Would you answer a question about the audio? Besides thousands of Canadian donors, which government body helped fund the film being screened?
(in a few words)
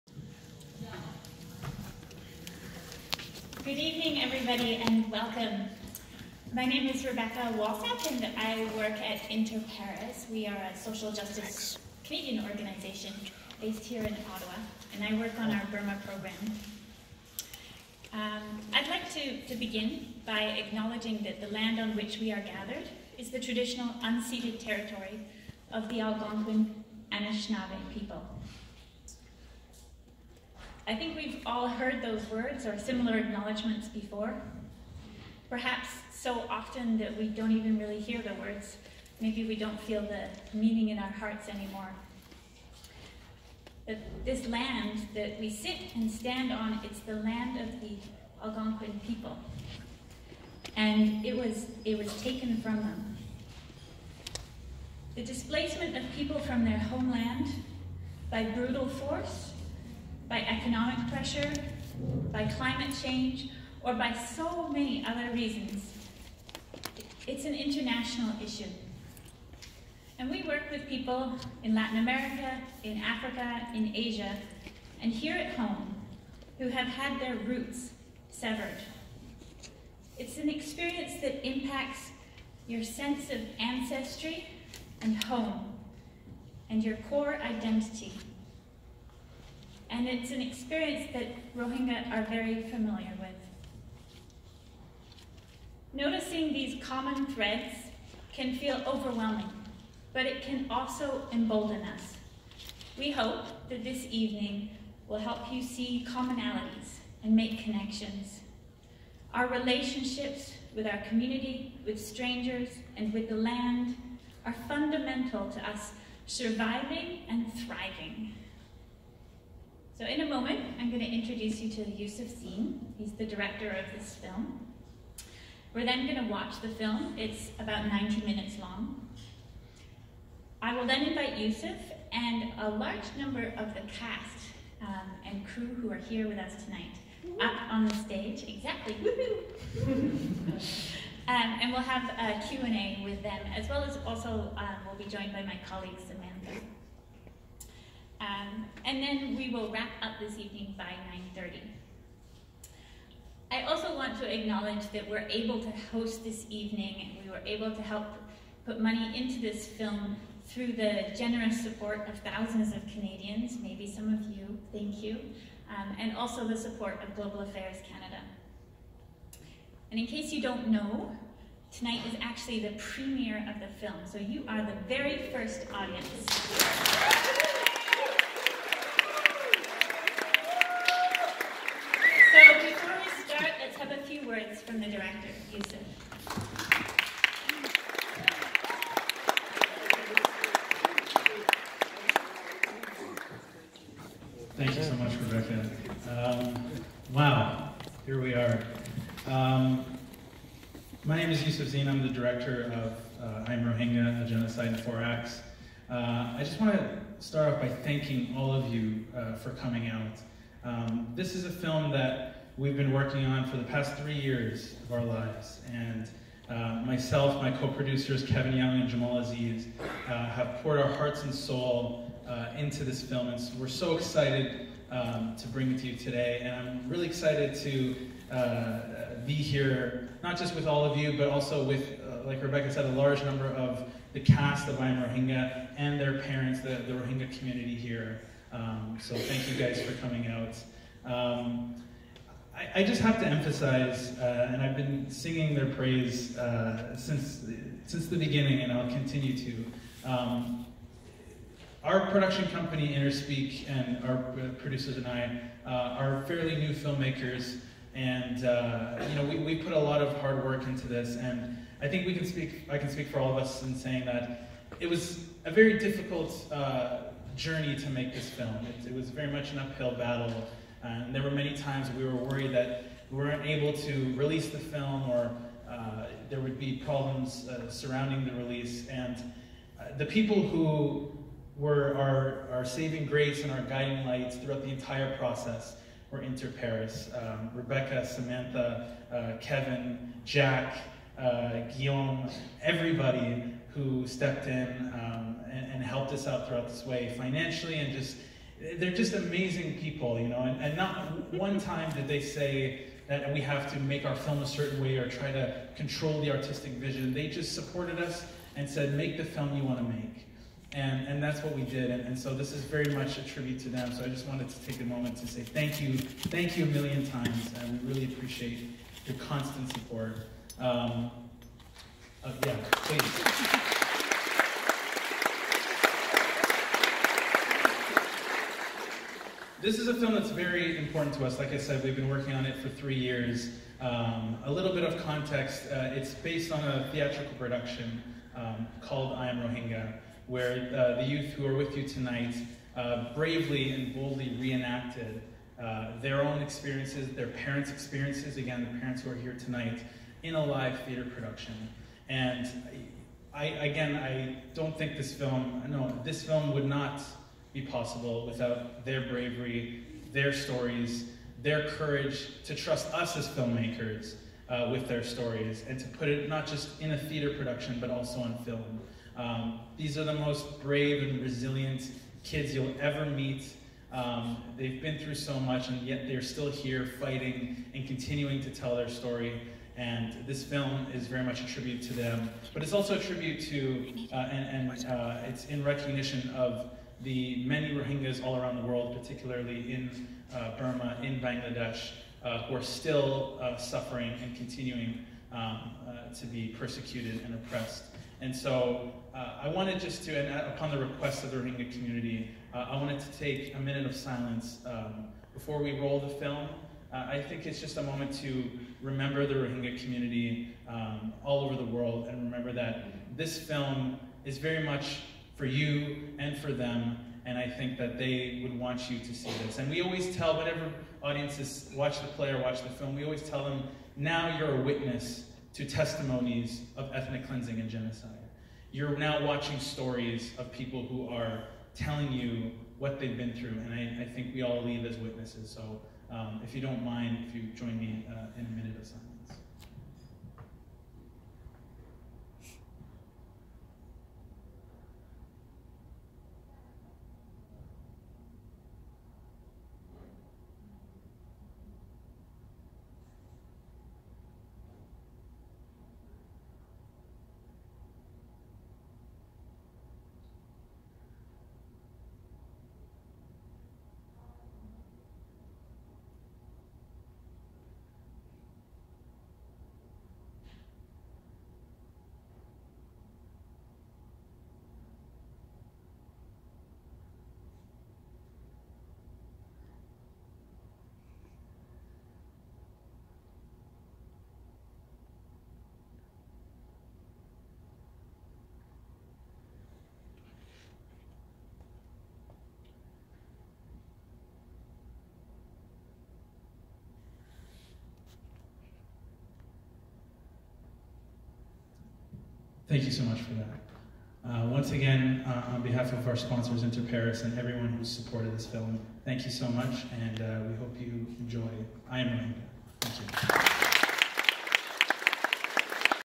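Global Affairs Canada.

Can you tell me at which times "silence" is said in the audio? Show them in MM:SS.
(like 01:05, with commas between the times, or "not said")
06:43, 07:18.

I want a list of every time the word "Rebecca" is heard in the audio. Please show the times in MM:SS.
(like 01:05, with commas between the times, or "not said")
00:07, 03:15, 03:52, 04:47.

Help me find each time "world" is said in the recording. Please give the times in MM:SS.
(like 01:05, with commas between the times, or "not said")
06:28, 06:51.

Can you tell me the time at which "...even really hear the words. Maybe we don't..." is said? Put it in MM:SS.
00:37.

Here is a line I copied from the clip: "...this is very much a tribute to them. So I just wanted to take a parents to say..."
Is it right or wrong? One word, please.
wrong.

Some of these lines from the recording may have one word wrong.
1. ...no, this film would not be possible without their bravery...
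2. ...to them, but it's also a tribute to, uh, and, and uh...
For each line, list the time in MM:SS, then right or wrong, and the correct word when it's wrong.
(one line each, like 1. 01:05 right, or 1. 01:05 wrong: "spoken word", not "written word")
1. 05:55 right
2. 06:21 right.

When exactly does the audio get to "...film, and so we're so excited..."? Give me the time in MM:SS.
03:43.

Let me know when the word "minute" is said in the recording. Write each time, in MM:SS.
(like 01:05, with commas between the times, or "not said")
02:08, 06:43, 07:18.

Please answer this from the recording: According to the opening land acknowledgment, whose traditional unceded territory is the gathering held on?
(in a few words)
Algonquin Anishinaabe.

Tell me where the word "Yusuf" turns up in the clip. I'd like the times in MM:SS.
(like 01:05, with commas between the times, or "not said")
02:01, 02:11, 03:21.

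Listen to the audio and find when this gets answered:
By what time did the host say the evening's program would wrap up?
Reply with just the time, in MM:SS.
02:31.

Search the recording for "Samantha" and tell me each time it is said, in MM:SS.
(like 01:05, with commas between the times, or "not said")
02:26, 04:48.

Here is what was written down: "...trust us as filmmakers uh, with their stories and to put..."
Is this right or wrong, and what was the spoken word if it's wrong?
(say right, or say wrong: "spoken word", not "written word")
right.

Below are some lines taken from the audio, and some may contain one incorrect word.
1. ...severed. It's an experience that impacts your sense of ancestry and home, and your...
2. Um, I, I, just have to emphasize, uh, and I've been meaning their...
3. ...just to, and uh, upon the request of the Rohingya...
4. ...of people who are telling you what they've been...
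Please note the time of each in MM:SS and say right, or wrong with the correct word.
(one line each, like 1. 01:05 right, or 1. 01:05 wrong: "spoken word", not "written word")
1. 01:18 right
2. 04:01 wrong: "singing", not "meaning"
3. 06:39 right
4. 07:10 right.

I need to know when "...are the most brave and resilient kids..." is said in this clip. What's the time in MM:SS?
06:09.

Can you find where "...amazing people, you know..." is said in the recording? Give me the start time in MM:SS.
04:59.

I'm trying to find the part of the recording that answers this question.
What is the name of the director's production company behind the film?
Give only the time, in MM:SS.
04:12.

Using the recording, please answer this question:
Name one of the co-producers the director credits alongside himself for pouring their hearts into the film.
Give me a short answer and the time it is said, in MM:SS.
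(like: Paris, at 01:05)
Kevin Young, at 03:38.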